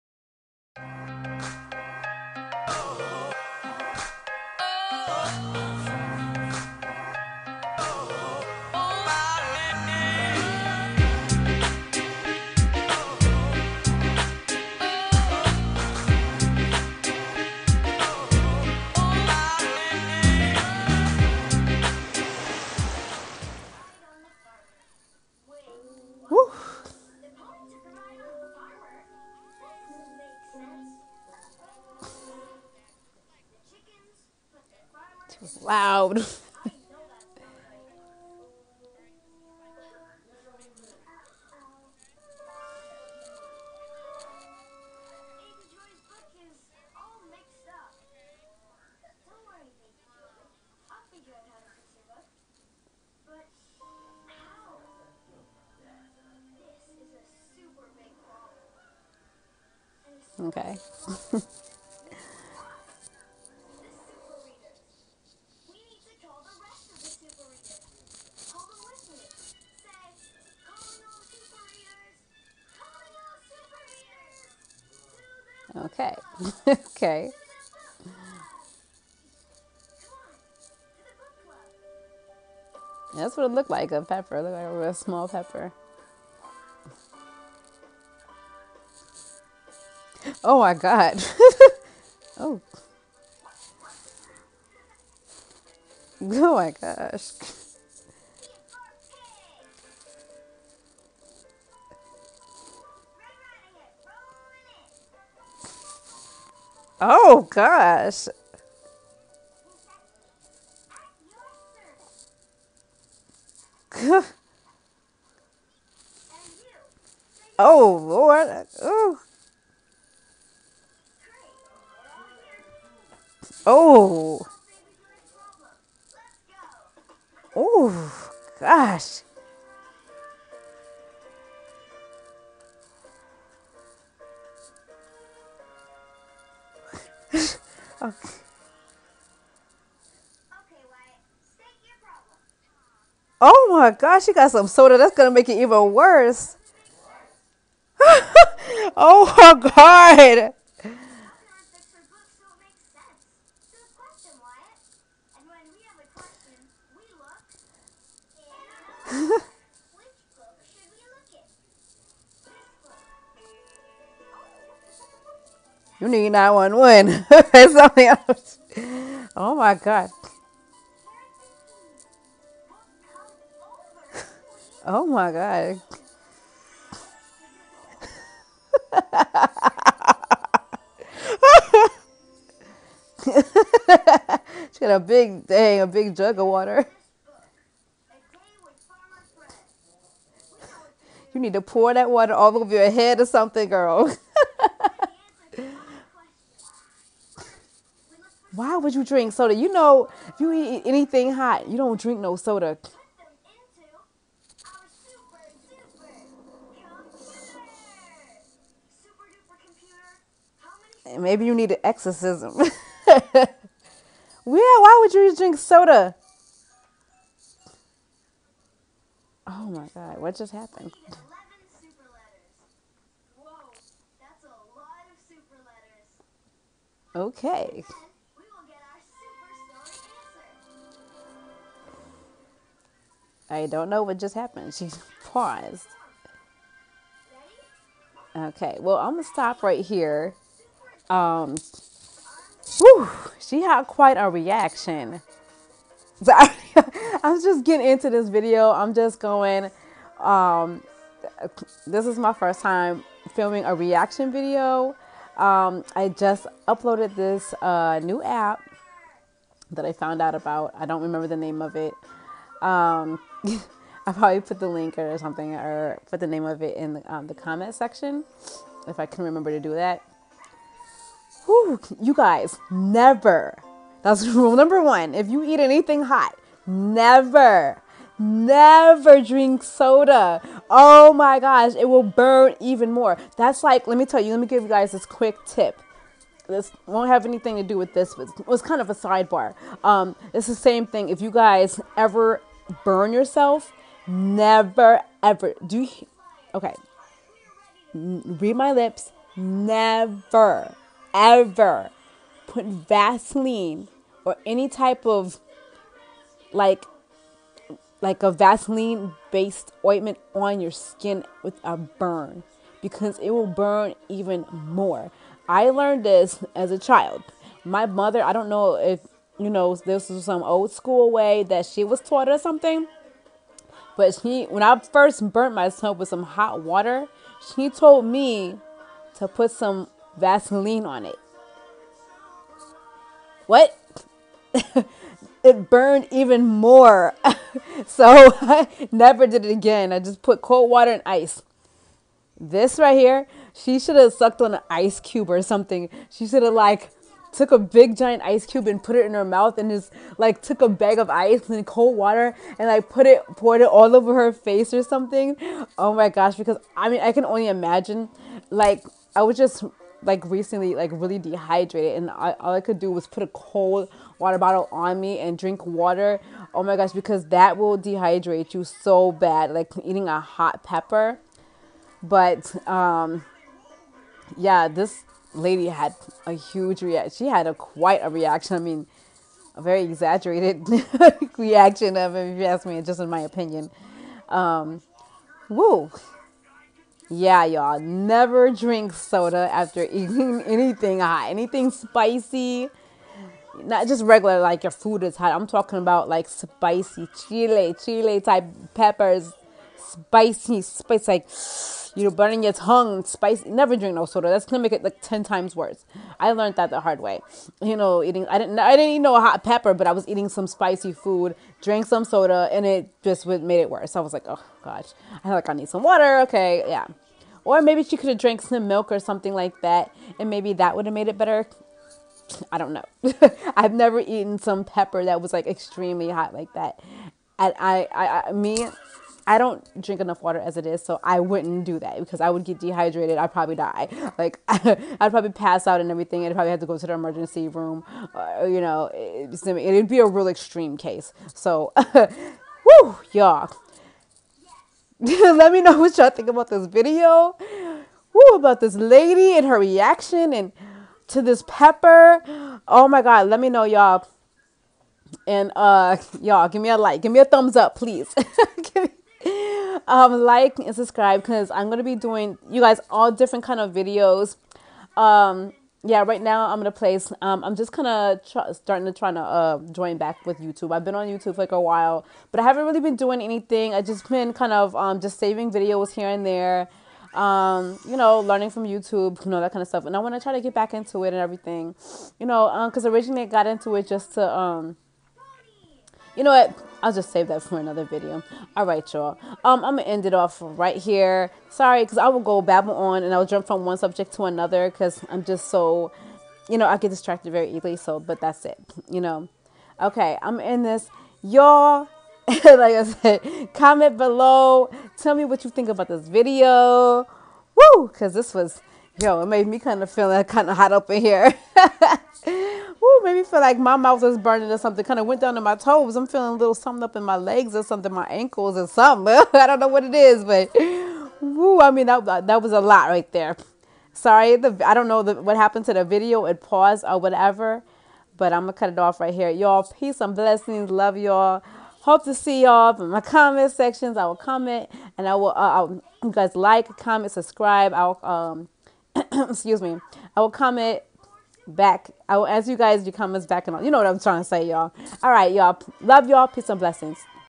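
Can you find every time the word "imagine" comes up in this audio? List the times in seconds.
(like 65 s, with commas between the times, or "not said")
357 s.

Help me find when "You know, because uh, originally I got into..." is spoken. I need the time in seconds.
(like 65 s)
482 s.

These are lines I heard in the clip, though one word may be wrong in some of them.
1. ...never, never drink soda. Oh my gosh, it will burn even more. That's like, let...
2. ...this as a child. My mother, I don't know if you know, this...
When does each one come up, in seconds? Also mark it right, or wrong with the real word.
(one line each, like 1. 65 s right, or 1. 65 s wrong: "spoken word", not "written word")
1. 276 s right
2. 316 s right.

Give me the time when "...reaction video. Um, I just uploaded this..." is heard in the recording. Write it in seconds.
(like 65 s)
253 s.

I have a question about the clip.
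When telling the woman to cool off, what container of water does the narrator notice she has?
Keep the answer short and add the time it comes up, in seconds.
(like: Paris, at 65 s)
a big jug, at 185 s.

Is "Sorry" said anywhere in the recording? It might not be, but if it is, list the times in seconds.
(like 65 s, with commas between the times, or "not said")
491 s, 523 s.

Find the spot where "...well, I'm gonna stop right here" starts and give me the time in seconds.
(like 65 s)
238 s.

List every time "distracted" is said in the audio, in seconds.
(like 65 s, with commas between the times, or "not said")
496 s.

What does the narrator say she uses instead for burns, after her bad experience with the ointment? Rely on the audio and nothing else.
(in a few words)
cold water and ice.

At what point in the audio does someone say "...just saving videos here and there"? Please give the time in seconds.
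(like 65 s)
474 s.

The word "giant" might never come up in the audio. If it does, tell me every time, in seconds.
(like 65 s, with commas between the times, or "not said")
347 s.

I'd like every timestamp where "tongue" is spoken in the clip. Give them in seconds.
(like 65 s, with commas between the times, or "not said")
402 s.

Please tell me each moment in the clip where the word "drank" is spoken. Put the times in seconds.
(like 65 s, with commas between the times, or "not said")
411 s, 418 s.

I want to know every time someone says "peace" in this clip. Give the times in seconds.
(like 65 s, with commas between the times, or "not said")
529 s, 546 s.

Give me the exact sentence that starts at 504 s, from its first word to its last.
Tell me what you think about this video.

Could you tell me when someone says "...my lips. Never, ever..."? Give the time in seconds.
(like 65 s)
298 s.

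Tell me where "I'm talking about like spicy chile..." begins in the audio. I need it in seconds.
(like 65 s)
395 s.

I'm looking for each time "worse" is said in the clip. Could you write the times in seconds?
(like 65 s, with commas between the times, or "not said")
405 s, 413 s.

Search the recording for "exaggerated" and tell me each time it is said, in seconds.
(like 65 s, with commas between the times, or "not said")
379 s.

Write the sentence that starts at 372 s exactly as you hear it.
But um yeah, this lady had a huge reaction.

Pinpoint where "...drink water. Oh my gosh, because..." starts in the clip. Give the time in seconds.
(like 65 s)
365 s.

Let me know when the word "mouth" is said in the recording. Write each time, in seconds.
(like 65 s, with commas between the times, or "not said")
349 s, 513 s.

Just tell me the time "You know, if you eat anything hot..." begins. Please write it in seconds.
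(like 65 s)
199 s.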